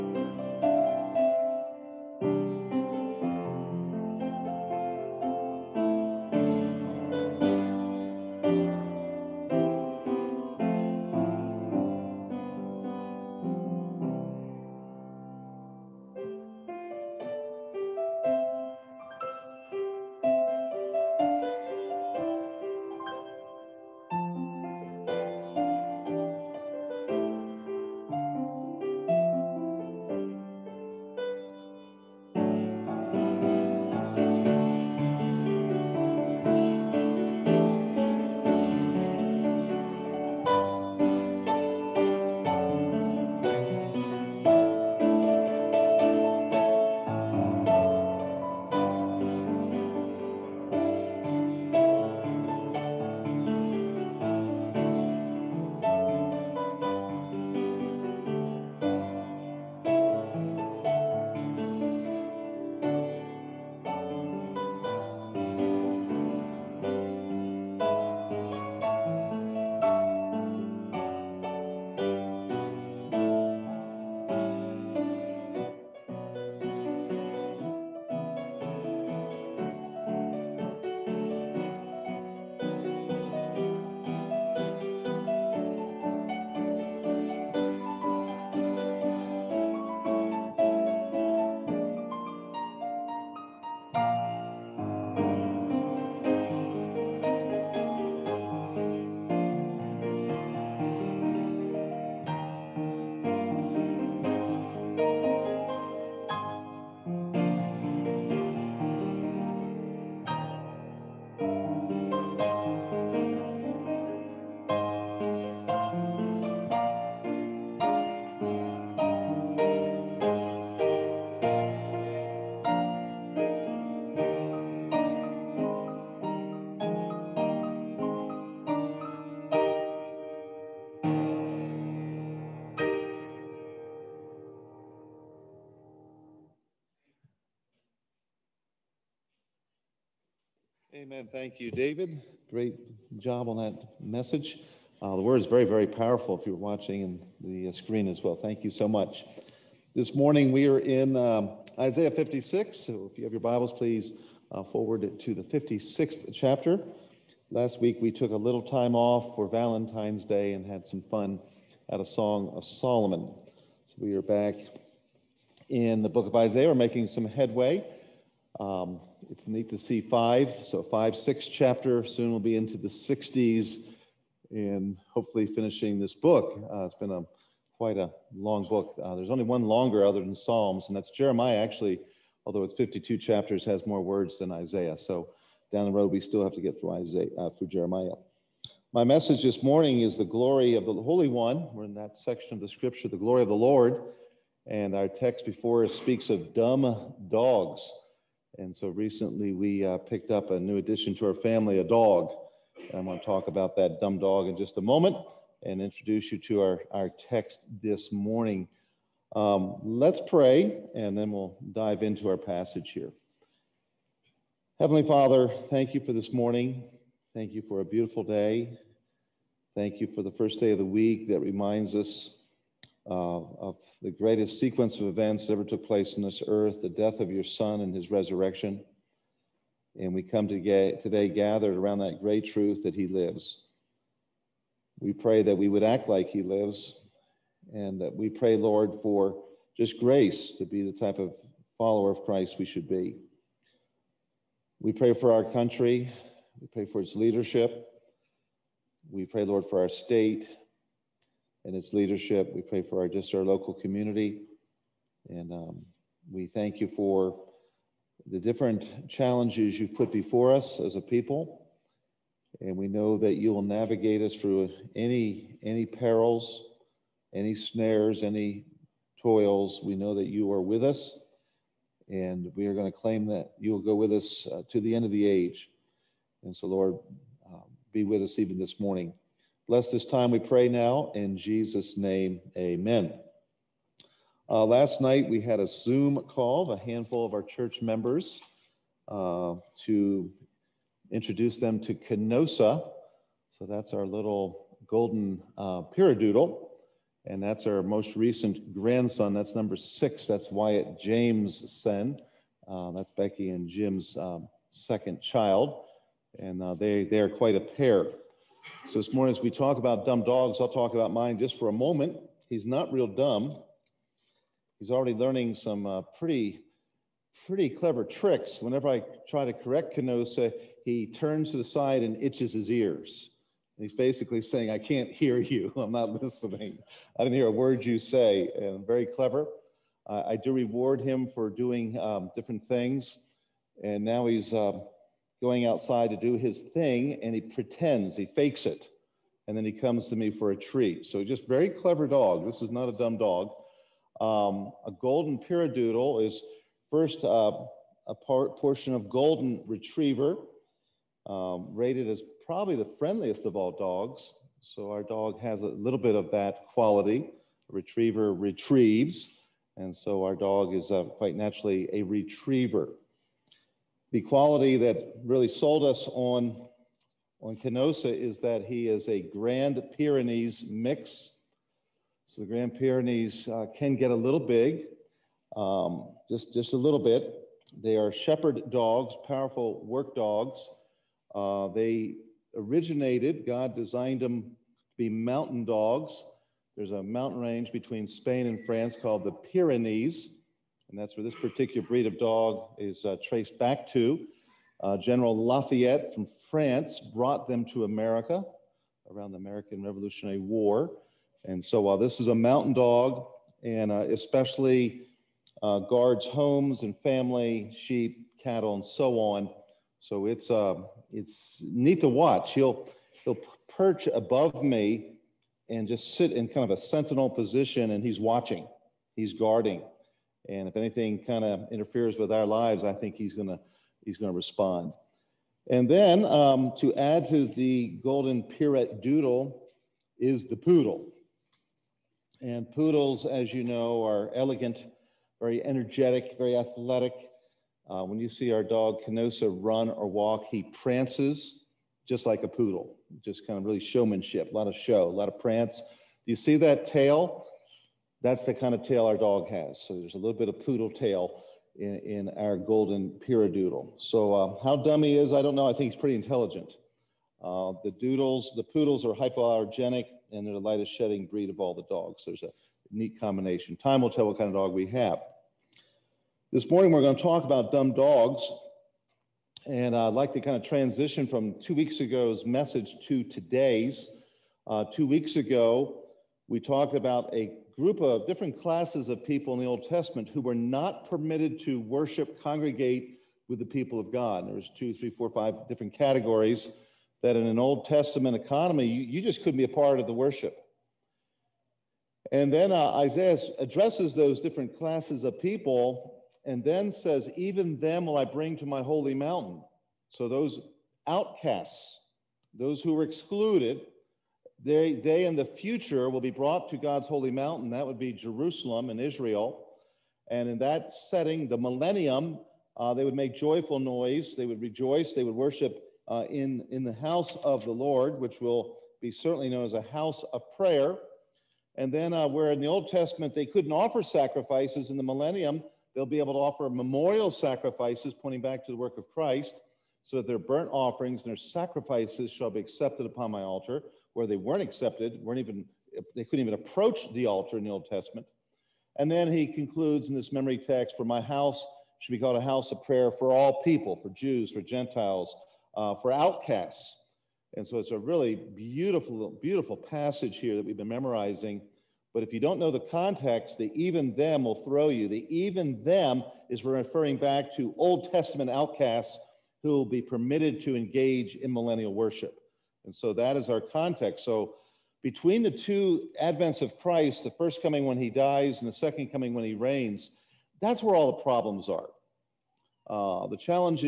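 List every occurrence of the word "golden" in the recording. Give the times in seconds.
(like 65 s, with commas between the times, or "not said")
294 s, 344 s, 349 s, 428 s, 452 s.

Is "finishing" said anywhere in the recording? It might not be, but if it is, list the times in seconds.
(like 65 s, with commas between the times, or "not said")
175 s.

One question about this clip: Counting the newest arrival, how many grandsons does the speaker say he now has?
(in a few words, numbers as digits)
6.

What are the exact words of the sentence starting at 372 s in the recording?
So the Grand Pyrenees uh, can get a little big, um, just, just a little bit.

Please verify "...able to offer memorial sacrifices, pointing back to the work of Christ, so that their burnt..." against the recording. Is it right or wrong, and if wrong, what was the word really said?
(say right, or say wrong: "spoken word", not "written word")
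right.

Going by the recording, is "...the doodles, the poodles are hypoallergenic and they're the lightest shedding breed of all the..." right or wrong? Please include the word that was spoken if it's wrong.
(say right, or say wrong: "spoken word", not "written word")
right.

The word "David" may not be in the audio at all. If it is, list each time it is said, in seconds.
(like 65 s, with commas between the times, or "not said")
141 s.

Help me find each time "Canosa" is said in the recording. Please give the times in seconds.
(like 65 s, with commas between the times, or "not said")
291 s, 319 s, 367 s, 439 s.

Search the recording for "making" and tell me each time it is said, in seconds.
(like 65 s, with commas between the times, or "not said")
166 s.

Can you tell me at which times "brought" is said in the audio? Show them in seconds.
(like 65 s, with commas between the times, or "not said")
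397 s, 506 s.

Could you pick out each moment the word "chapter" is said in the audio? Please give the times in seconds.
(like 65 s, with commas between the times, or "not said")
156 s, 171 s, 183 s.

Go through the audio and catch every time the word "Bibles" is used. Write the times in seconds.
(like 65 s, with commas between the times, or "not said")
153 s.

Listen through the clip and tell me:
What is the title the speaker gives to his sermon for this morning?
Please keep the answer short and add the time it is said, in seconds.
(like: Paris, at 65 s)
The glory of the Holy One, at 190 s.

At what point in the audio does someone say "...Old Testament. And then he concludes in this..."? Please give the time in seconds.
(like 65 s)
537 s.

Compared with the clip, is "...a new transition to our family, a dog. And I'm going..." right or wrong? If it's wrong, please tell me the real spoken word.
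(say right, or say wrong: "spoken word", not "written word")
wrong: "addition", not "transition".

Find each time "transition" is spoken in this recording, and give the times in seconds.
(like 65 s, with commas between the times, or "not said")
470 s.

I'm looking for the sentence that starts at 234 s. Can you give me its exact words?
We pray that we would act like he lives.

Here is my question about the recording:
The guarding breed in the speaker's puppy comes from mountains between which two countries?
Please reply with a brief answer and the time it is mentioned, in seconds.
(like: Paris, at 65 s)
Spain and France, at 388 s.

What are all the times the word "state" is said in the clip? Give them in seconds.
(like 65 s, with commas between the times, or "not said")
249 s.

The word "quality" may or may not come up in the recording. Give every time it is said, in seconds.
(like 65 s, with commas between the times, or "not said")
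356 s, 364 s.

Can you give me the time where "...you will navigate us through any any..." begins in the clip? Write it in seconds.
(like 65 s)
263 s.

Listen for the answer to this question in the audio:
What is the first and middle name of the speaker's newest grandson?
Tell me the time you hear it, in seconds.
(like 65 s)
300 s.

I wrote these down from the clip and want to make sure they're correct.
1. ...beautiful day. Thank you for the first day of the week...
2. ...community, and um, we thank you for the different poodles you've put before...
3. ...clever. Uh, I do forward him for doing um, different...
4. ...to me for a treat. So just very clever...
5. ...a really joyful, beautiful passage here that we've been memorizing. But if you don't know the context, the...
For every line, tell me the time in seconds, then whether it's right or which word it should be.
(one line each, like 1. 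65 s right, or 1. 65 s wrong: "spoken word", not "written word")
1. 217 s right
2. 253 s wrong: "challenges", not "poodles"
3. 329 s wrong: "reward", not "forward"
4. 340 s right
5. 547 s wrong: "beautiful", not "joyful".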